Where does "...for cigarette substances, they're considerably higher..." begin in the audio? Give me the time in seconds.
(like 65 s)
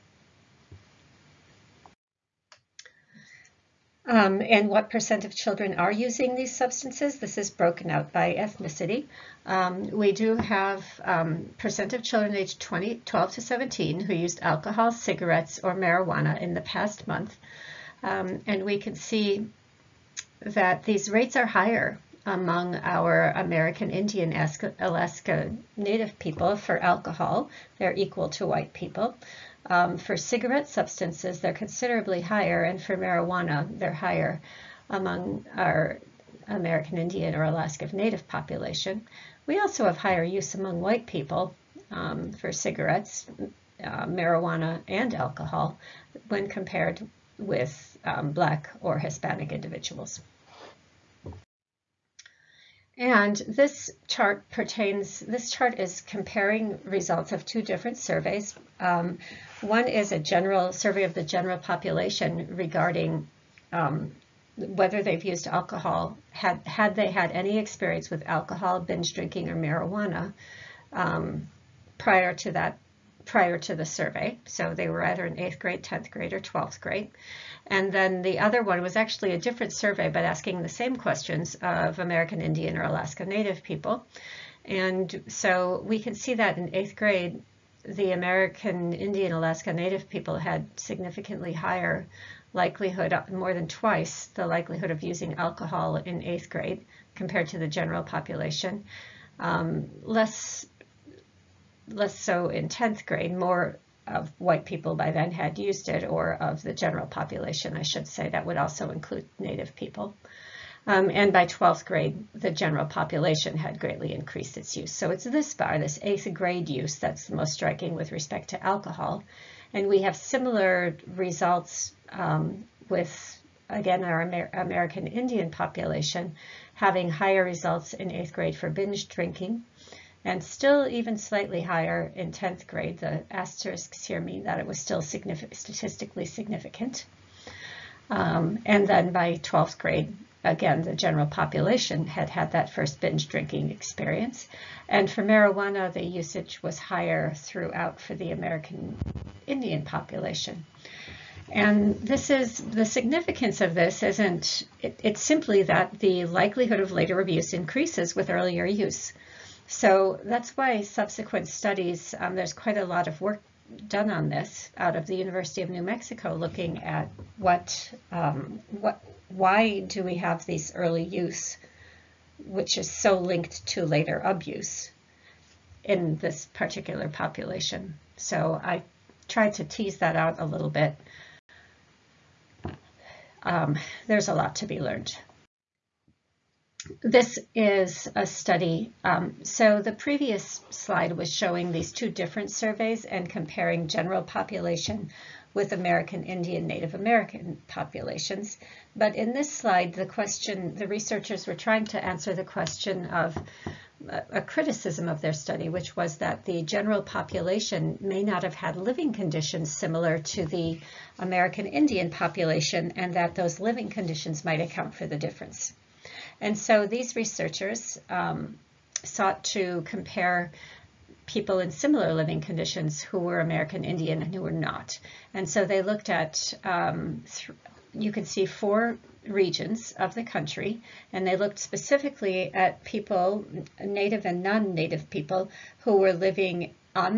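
29 s.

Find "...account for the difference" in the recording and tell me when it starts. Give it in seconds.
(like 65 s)
214 s.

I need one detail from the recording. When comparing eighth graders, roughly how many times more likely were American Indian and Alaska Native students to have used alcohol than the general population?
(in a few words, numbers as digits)
More than twice.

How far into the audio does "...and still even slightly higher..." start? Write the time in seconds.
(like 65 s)
130 s.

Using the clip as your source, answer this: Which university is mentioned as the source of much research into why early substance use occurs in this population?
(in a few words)
University of New Mexico.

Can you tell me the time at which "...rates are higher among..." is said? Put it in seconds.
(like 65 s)
21 s.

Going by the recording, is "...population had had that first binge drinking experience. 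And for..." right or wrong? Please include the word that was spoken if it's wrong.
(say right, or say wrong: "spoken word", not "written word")
right.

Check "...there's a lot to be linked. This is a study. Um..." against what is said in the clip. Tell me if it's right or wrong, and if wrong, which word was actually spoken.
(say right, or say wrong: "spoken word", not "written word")
wrong: "learned", not "linked".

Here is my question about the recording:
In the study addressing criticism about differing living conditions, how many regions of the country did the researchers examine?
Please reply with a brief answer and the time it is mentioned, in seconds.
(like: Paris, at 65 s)
4, at 228 s.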